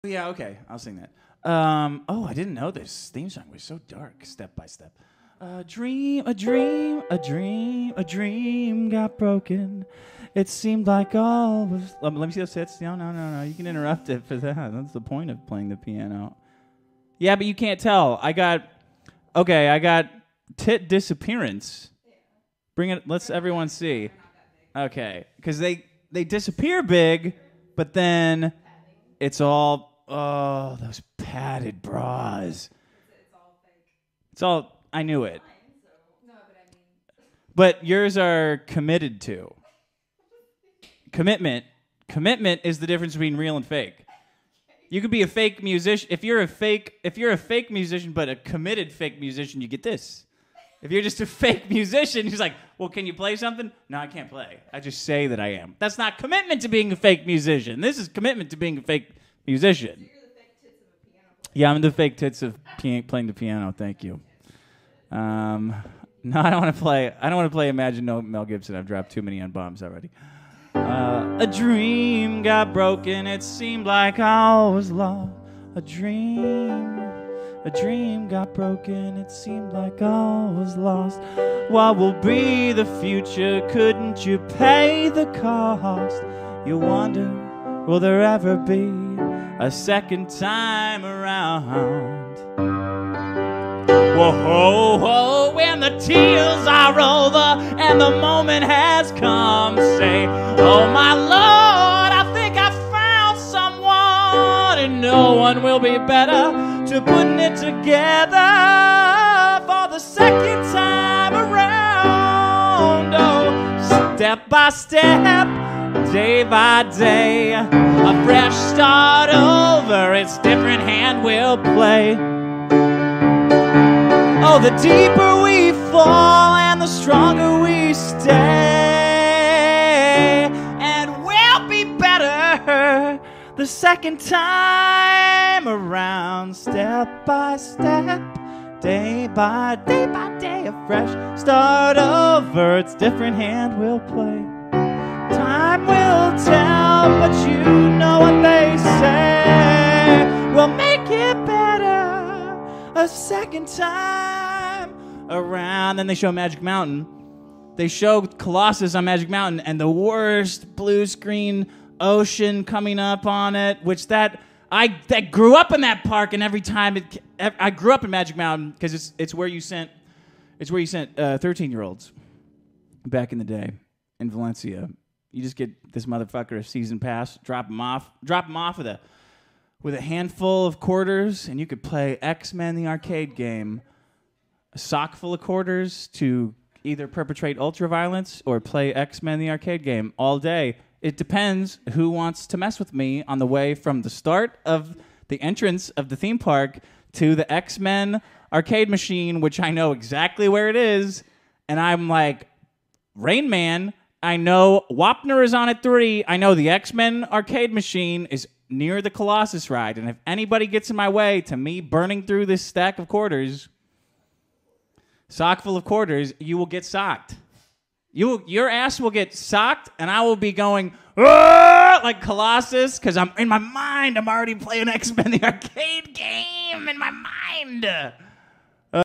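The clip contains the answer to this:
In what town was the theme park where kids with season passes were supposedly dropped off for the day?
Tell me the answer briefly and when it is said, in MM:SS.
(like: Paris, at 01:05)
Valencia, at 02:54.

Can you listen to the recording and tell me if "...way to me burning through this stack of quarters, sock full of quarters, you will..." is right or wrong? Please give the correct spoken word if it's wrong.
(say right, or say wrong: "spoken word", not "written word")
right.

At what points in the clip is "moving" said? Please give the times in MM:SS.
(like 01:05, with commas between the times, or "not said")
not said.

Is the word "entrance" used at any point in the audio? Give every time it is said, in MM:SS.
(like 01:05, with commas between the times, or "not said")
03:15.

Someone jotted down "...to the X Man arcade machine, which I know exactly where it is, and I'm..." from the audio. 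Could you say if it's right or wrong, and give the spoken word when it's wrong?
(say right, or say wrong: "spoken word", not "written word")
wrong: "Men", not "Man".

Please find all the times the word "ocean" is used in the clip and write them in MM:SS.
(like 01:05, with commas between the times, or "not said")
02:42.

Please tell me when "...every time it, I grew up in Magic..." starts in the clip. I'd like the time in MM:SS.
02:46.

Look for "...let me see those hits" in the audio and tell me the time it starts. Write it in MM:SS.
00:12.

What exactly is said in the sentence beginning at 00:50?
If you're just a fake musician, he's like, well, can you play something?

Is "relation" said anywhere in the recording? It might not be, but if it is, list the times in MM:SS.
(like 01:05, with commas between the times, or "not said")
not said.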